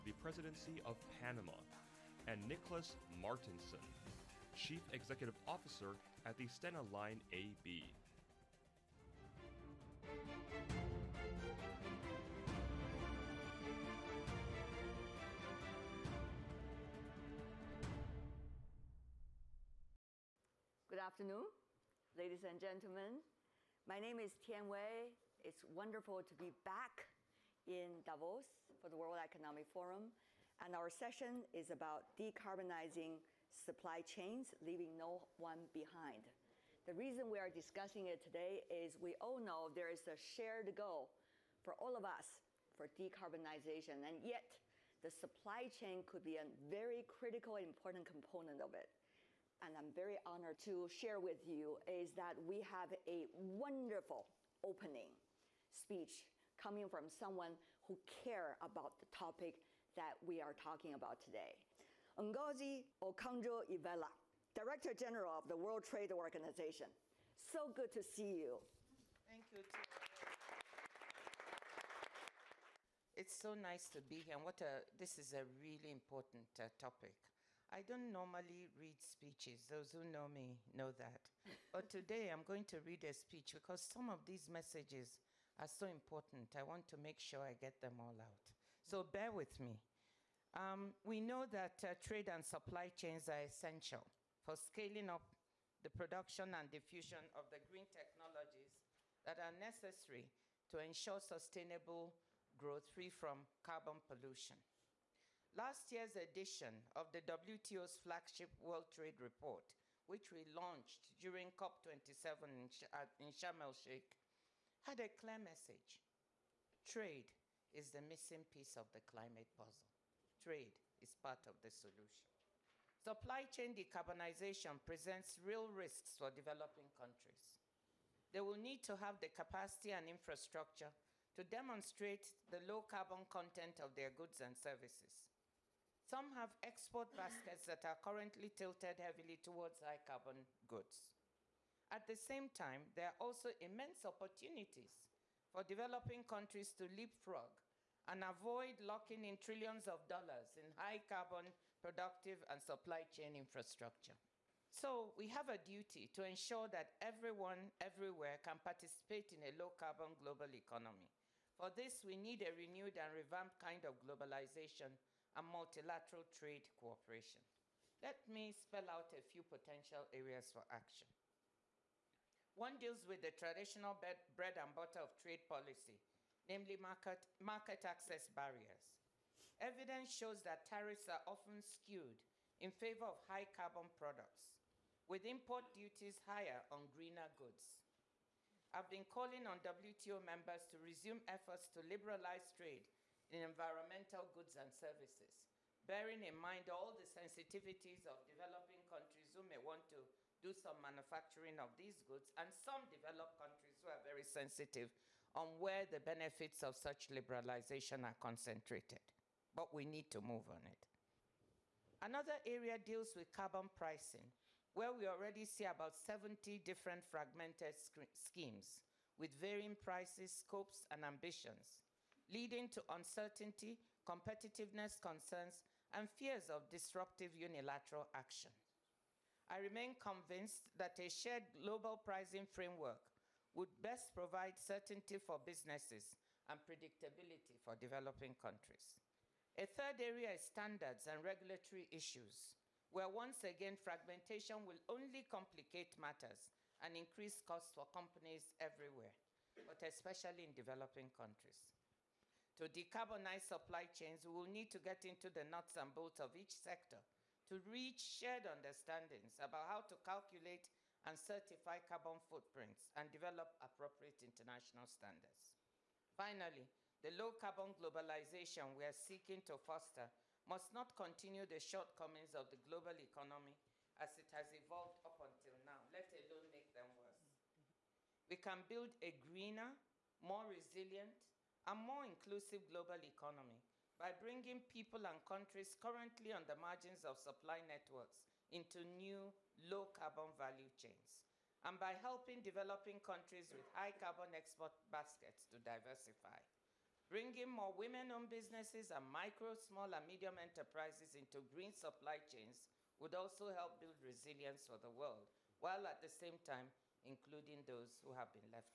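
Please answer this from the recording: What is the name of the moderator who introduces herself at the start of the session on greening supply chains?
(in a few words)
Tian Wei.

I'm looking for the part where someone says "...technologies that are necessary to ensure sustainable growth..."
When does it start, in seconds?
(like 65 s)
97 s.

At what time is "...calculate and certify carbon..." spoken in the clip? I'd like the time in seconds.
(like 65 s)
259 s.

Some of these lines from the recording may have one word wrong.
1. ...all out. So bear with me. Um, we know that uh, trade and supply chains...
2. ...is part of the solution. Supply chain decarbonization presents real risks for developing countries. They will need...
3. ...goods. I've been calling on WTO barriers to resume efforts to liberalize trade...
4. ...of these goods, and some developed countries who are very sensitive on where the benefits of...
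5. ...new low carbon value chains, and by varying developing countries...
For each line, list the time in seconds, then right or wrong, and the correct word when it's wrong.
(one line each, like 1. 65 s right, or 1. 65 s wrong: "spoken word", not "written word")
1. 87 s right
2. 121 s right
3. 187 s wrong: "members", not "barriers"
4. 201 s right
5. 288 s wrong: "helping", not "varying".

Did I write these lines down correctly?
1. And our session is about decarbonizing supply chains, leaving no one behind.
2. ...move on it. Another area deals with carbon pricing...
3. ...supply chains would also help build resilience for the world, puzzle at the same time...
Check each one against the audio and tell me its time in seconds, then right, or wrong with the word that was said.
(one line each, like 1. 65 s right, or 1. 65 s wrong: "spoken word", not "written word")
1. 30 s right
2. 210 s right
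3. 301 s wrong: "while", not "puzzle".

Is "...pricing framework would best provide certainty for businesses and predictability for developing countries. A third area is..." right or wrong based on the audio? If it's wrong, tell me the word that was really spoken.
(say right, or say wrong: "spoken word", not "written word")
right.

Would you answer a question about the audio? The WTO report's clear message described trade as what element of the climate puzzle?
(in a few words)
the missing piece.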